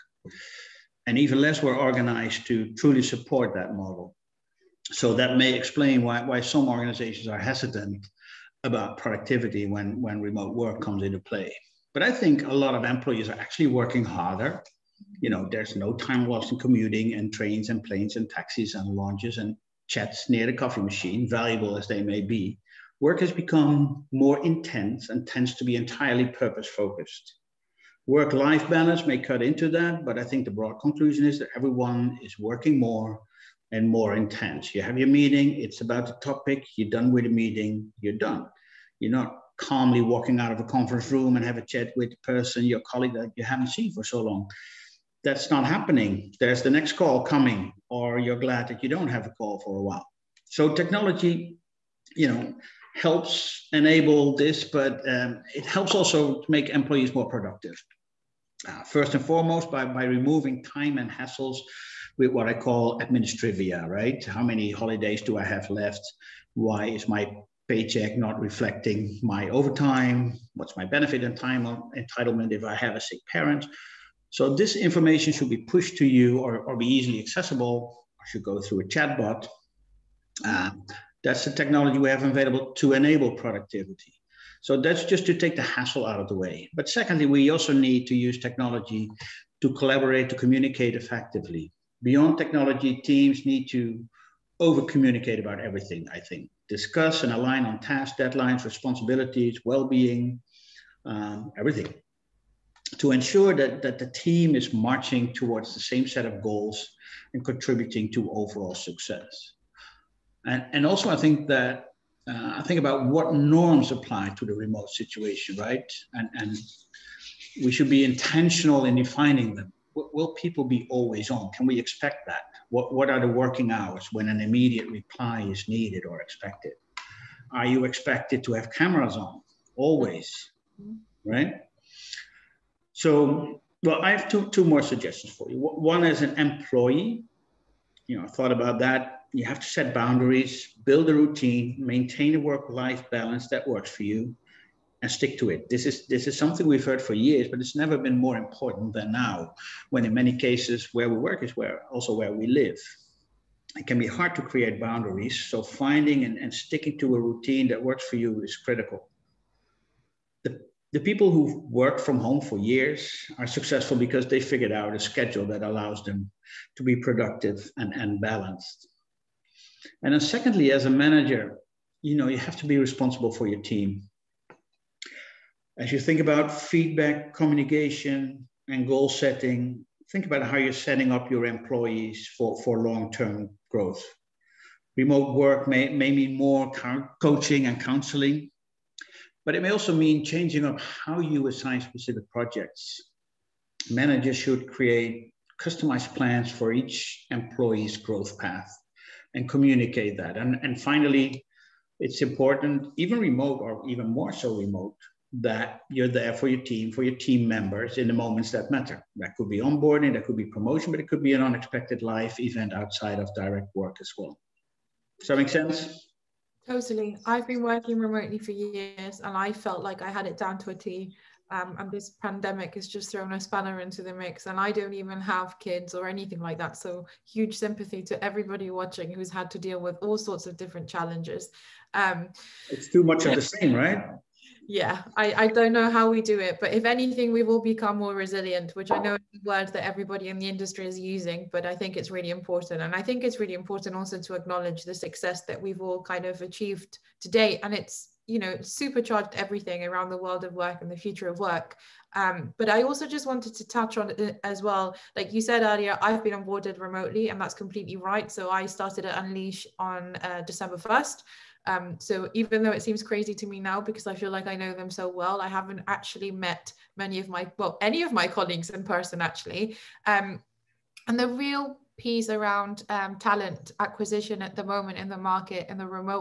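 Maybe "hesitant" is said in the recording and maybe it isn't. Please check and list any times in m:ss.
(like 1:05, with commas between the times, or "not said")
0:07.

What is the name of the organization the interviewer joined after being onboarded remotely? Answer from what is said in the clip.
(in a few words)
Unleash.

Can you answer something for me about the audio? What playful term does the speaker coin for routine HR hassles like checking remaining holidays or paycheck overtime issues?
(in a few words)
administrivia.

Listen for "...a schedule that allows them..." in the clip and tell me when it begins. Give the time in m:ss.
2:44.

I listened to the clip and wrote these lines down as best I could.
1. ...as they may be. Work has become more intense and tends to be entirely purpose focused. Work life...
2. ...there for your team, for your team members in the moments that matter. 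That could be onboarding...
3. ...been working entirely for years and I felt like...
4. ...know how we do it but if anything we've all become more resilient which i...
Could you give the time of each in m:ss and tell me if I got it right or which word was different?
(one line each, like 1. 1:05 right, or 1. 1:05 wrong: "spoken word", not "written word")
1. 0:21 right
2. 3:26 right
3. 3:37 wrong: "remotely", not "entirely"
4. 3:55 right.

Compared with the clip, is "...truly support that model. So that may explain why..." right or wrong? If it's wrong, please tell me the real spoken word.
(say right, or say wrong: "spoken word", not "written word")
right.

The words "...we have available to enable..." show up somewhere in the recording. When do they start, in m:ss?
1:21.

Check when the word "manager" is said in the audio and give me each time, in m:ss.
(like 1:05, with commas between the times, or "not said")
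2:50, 3:13.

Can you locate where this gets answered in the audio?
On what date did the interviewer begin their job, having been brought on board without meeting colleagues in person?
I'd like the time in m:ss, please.
4:20.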